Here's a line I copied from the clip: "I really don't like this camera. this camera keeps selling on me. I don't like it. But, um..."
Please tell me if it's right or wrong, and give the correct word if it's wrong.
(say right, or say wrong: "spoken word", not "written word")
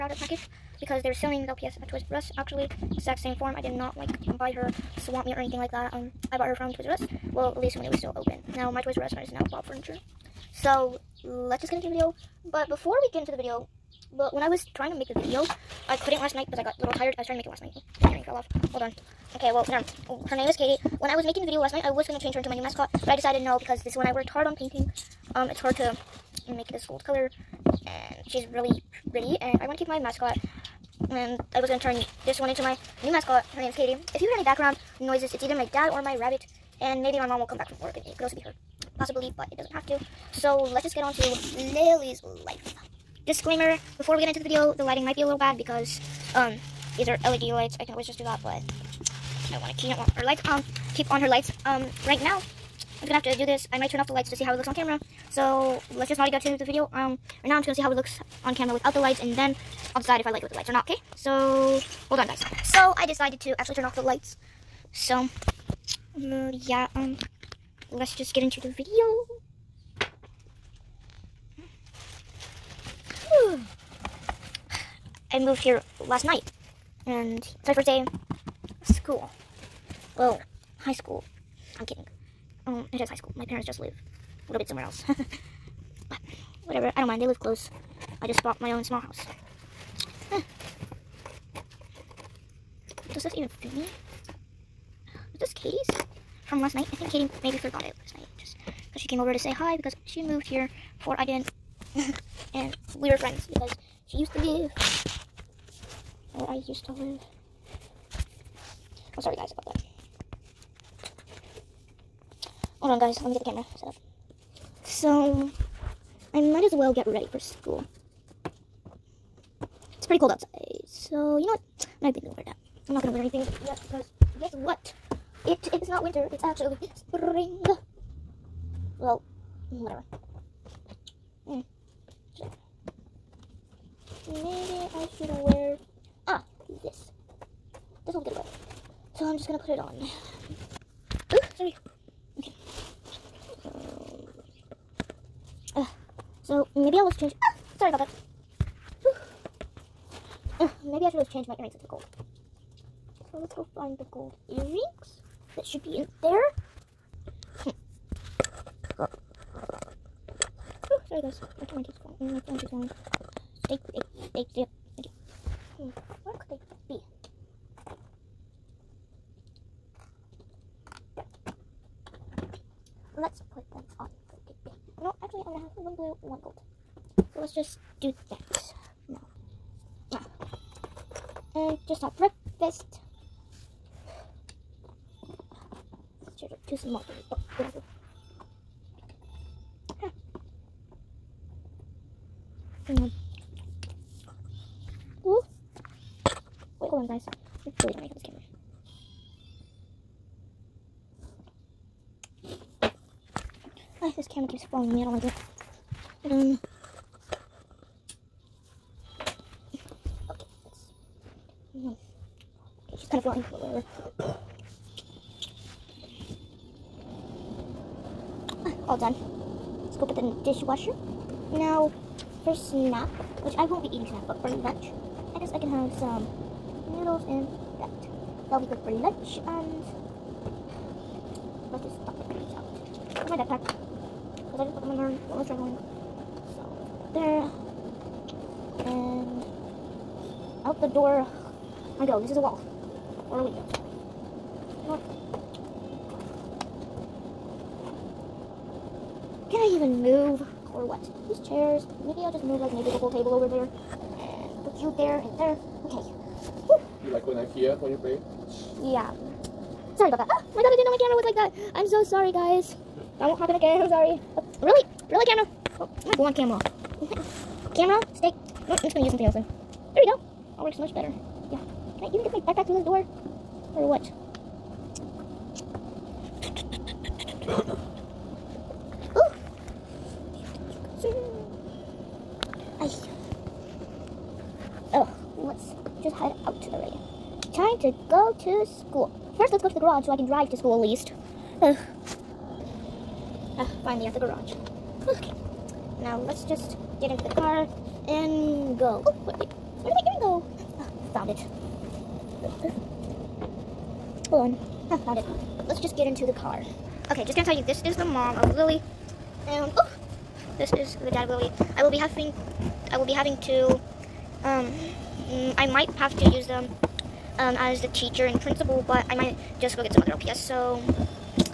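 wrong: "falling", not "selling".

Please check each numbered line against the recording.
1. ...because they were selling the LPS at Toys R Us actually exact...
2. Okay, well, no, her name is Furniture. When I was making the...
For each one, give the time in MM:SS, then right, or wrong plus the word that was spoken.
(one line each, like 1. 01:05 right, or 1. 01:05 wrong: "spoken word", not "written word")
1. 00:00 right
2. 00:19 wrong: "Katie", not "Furniture".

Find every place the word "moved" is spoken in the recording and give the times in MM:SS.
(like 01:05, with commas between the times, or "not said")
01:15, 01:40.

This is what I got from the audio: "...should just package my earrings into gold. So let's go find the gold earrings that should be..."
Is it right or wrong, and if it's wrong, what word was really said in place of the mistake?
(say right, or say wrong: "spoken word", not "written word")
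wrong: "change", not "package".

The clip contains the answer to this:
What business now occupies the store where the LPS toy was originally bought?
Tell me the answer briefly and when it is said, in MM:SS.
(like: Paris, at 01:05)
Bob Furniture, at 00:09.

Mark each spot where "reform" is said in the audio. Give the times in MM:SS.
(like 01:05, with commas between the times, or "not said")
not said.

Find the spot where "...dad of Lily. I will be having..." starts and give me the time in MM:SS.
05:11.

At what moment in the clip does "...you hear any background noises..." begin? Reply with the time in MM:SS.
00:34.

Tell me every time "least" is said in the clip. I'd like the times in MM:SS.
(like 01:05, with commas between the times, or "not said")
00:07, 04:50.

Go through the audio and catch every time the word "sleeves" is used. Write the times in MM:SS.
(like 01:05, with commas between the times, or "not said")
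not said.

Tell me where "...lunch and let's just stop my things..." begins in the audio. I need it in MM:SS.
03:48.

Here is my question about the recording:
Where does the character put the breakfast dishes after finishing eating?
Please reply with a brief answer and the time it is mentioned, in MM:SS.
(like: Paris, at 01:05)
Dishwasher, at 03:40.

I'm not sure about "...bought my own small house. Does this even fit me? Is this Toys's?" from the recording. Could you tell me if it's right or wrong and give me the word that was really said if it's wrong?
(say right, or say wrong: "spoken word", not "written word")
wrong: "Katie", not "Toys".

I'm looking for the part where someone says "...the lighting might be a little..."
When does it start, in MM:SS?
00:44.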